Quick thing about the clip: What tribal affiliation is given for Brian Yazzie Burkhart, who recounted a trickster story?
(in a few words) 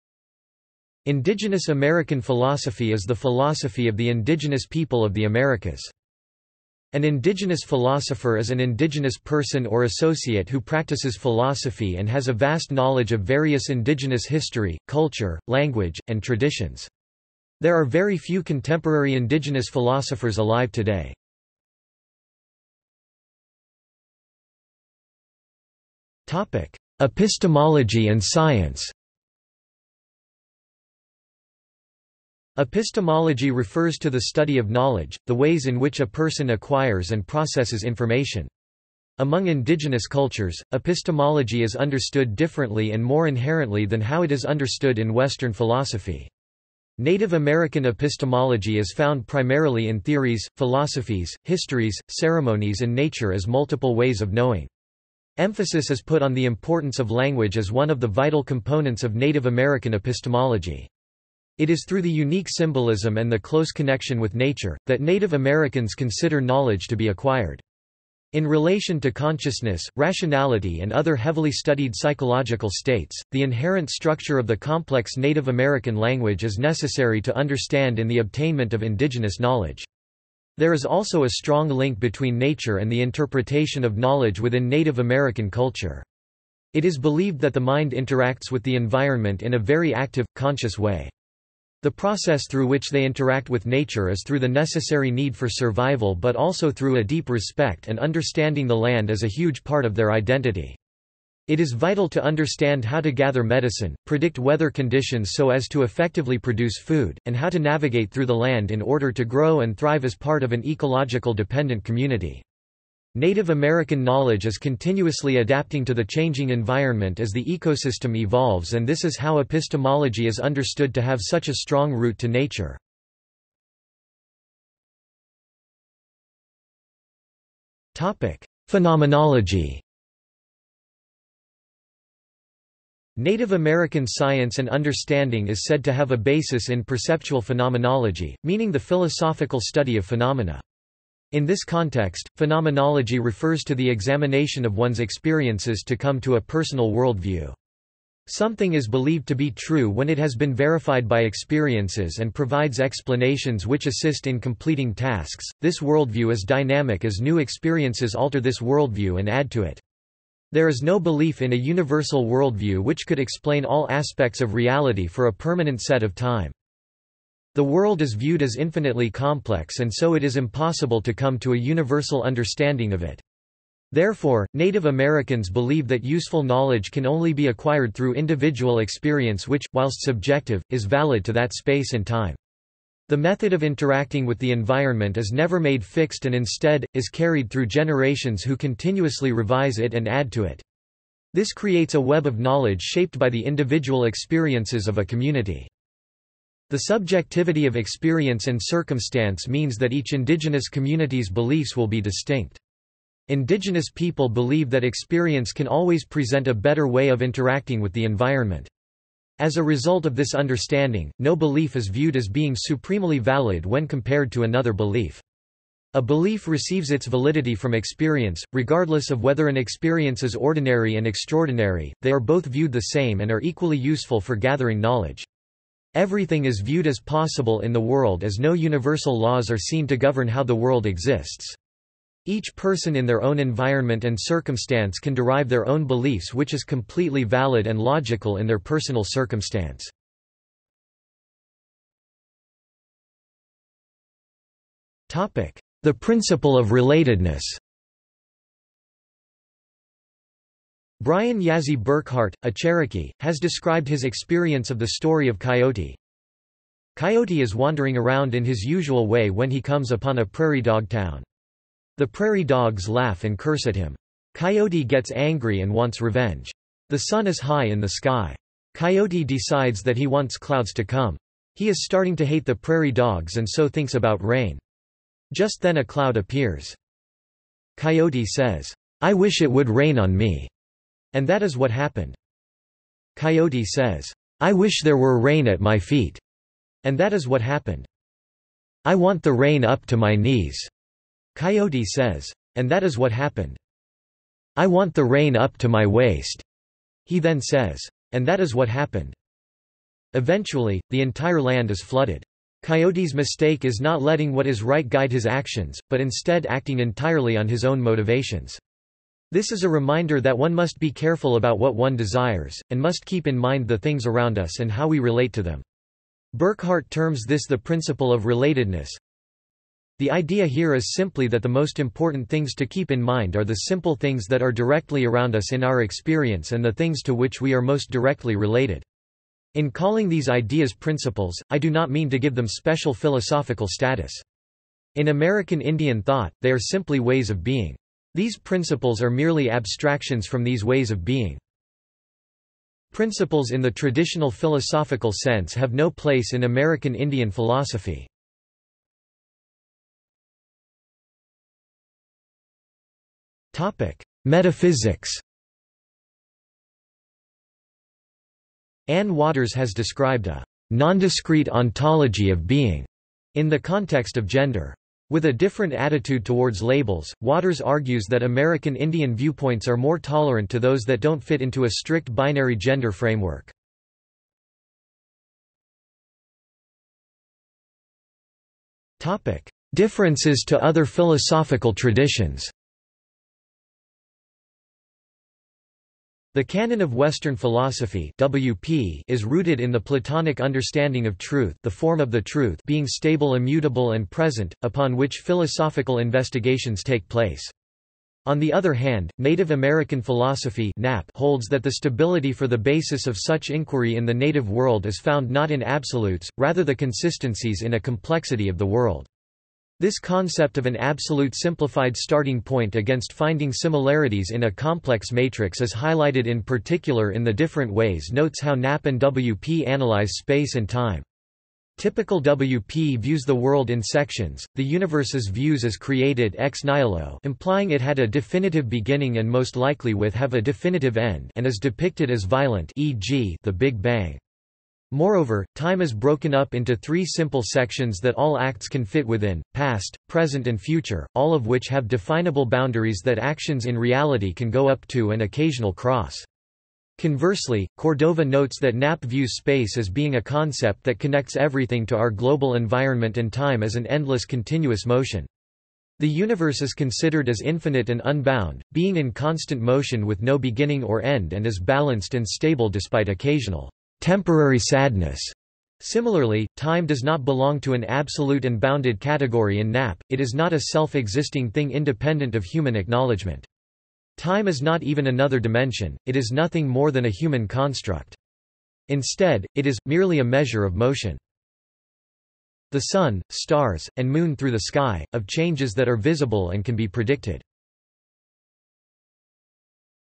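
Cherokee.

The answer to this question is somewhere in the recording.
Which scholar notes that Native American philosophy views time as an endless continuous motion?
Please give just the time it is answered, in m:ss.
7:27.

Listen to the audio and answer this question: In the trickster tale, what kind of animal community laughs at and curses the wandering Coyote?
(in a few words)
prairie dog town.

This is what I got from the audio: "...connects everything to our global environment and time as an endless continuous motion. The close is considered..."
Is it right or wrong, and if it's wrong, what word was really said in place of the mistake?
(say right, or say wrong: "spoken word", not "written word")
wrong: "universe", not "close".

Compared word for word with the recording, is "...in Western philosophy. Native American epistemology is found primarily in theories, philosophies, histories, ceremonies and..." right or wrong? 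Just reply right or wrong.
right.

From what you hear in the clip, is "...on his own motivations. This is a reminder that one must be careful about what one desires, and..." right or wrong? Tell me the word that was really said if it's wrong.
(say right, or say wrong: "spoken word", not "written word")
right.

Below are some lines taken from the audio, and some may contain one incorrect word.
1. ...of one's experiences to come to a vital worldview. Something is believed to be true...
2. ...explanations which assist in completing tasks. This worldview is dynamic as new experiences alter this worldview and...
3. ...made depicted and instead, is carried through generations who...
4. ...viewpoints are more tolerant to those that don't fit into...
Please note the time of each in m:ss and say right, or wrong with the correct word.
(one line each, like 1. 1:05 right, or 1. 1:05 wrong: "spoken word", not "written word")
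1. 2:24 wrong: "personal", not "vital"
2. 2:32 right
3. 3:05 wrong: "fixed", not "depicted"
4. 6:09 right.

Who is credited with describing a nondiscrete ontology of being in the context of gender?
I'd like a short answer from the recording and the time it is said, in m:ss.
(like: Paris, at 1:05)
Anne Waters, at 5:58.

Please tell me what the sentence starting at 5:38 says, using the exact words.
These principles are merely abstractions from these ways of being.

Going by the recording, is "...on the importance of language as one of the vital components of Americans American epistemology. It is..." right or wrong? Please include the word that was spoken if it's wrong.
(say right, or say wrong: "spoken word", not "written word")
wrong: "Native", not "Americans".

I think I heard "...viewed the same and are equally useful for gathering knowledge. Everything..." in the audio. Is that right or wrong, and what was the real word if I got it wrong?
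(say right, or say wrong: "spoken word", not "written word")
right.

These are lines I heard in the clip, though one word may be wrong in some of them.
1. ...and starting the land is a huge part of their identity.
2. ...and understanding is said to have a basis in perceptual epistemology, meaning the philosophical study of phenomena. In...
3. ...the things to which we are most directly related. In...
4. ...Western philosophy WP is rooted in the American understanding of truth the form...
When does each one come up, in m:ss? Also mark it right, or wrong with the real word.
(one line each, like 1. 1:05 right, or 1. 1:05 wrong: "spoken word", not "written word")
1. 1:37 wrong: "understanding", not "starting"
2. 2:14 wrong: "phenomenology", not "epistemology"
3. 5:26 right
4. 6:26 wrong: "Platonic", not "American".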